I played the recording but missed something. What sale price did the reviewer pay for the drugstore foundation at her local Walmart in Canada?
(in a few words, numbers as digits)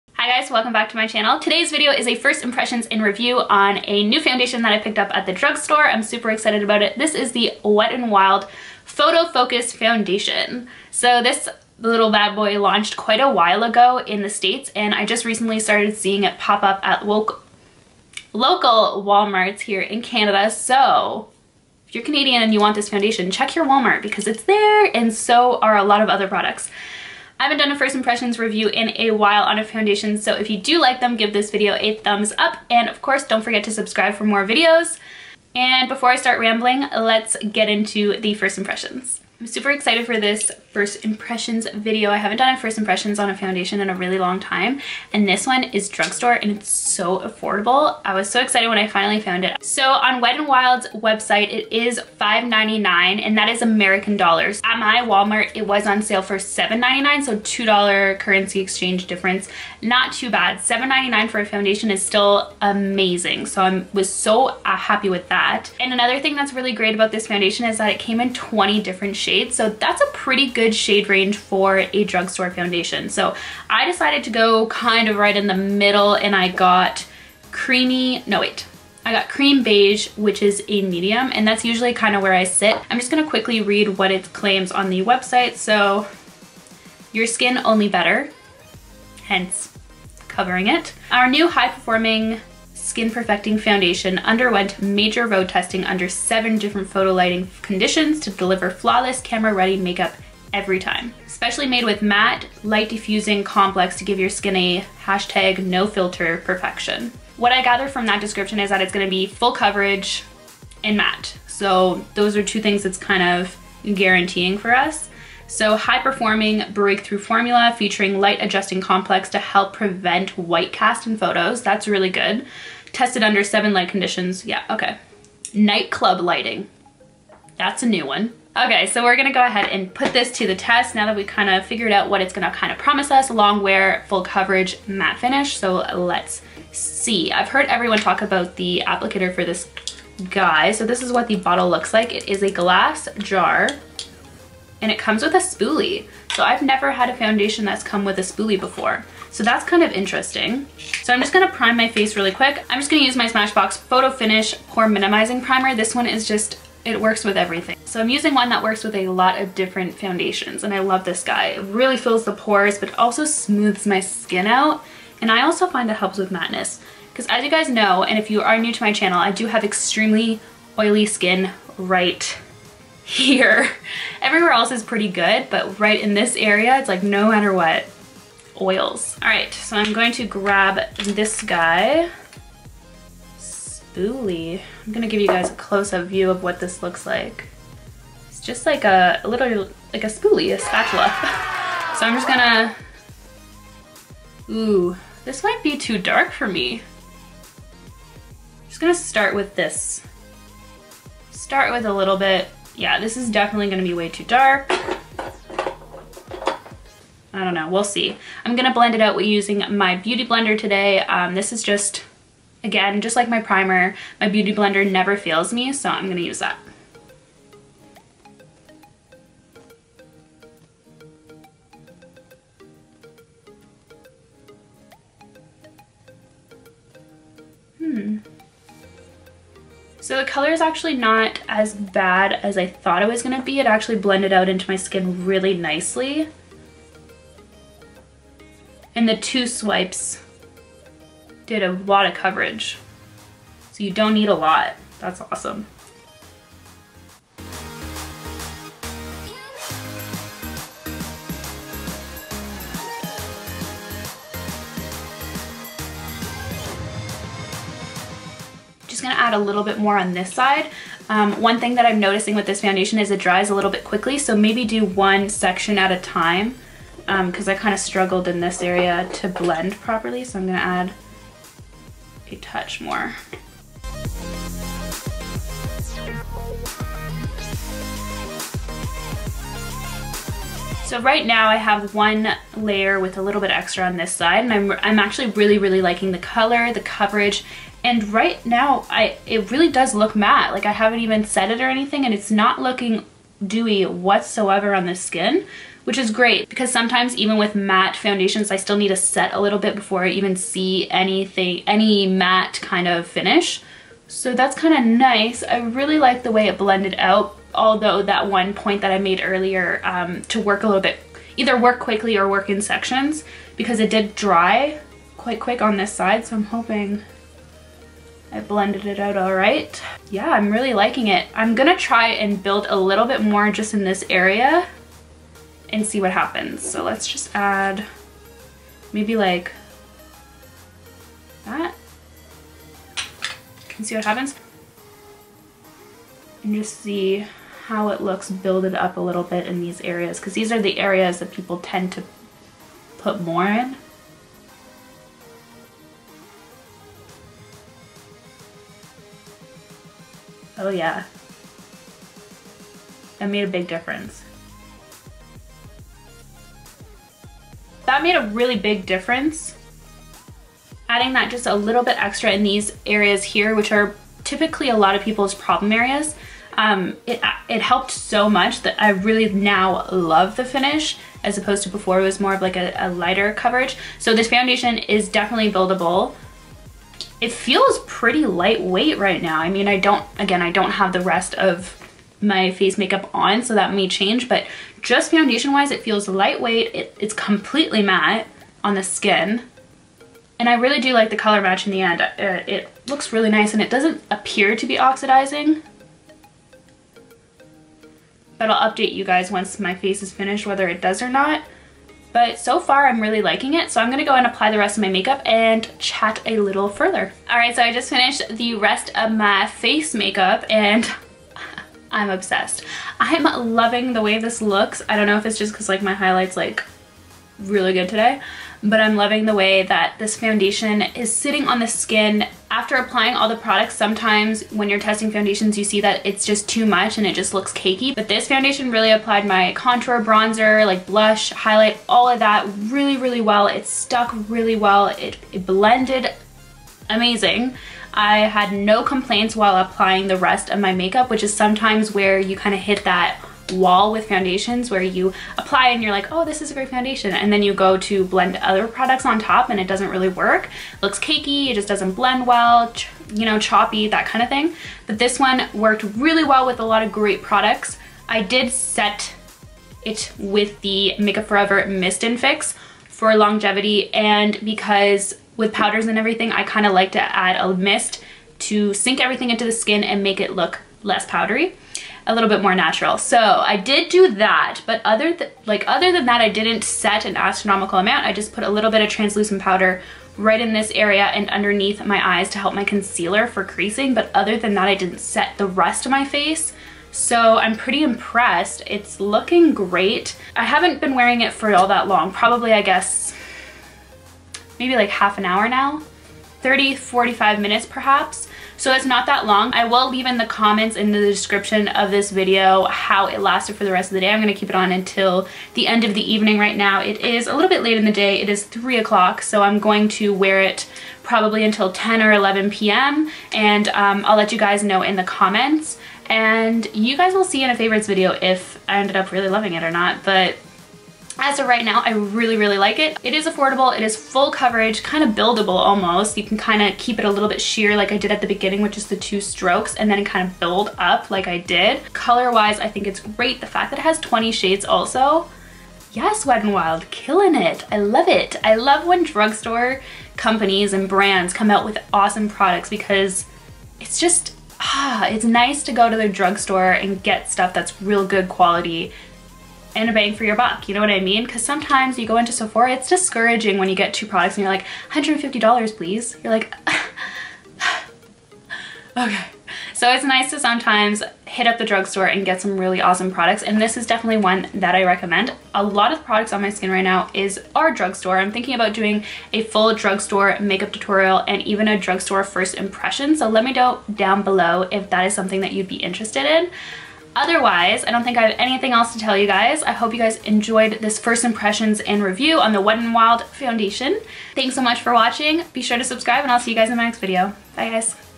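$7.99.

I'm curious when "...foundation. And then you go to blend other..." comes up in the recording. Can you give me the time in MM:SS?
07:26.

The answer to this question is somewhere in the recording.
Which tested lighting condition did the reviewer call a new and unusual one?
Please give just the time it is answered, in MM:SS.
02:05.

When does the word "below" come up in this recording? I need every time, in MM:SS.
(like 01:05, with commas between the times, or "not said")
09:34.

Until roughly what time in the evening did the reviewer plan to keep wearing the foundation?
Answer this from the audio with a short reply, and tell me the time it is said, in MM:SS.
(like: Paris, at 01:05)
10 or 11 p.m., at 08:31.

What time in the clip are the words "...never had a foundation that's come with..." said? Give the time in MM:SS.
02:26.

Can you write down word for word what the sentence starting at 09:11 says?
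Because sometimes you go into Sephora, it's discouraging when you get two products and you're like, $150 please.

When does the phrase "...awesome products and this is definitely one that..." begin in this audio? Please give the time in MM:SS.
09:22.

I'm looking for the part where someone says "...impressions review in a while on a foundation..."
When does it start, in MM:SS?
00:27.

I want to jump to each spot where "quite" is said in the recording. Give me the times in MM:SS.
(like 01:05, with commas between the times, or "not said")
00:12, 05:15.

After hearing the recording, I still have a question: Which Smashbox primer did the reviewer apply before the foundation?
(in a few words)
Photo Finish Pore Minimizing Primer.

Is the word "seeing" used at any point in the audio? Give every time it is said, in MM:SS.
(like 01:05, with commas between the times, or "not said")
00:15.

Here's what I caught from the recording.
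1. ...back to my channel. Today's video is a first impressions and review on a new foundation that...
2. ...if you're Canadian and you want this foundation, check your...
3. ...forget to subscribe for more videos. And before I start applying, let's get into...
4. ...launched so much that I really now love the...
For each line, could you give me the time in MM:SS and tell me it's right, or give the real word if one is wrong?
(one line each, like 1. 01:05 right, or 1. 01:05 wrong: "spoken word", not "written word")
1. 00:00 right
2. 00:21 right
3. 00:33 wrong: "rambling", not "applying"
4. 06:07 wrong: "helped", not "launched".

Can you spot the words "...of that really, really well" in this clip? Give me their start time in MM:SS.
07:12.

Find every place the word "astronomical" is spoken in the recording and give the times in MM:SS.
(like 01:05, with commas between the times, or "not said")
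07:57.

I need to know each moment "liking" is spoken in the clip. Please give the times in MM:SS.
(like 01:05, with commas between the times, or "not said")
04:45, 05:20, 06:43.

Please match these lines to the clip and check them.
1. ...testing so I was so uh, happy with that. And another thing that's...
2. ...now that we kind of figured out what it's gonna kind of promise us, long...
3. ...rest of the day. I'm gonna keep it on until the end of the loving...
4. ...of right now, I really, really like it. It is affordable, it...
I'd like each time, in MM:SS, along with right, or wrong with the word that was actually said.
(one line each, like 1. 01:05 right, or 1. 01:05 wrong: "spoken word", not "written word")
1. 01:02 wrong: "amazing", not "testing"
2. 02:10 right
3. 08:23 wrong: "evening", not "loving"
4. 08:41 right.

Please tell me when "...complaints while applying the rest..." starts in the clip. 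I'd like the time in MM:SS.
07:18.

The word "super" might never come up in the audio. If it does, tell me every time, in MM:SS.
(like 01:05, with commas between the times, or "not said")
00:06, 00:39.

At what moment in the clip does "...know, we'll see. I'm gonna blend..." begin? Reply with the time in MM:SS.
03:27.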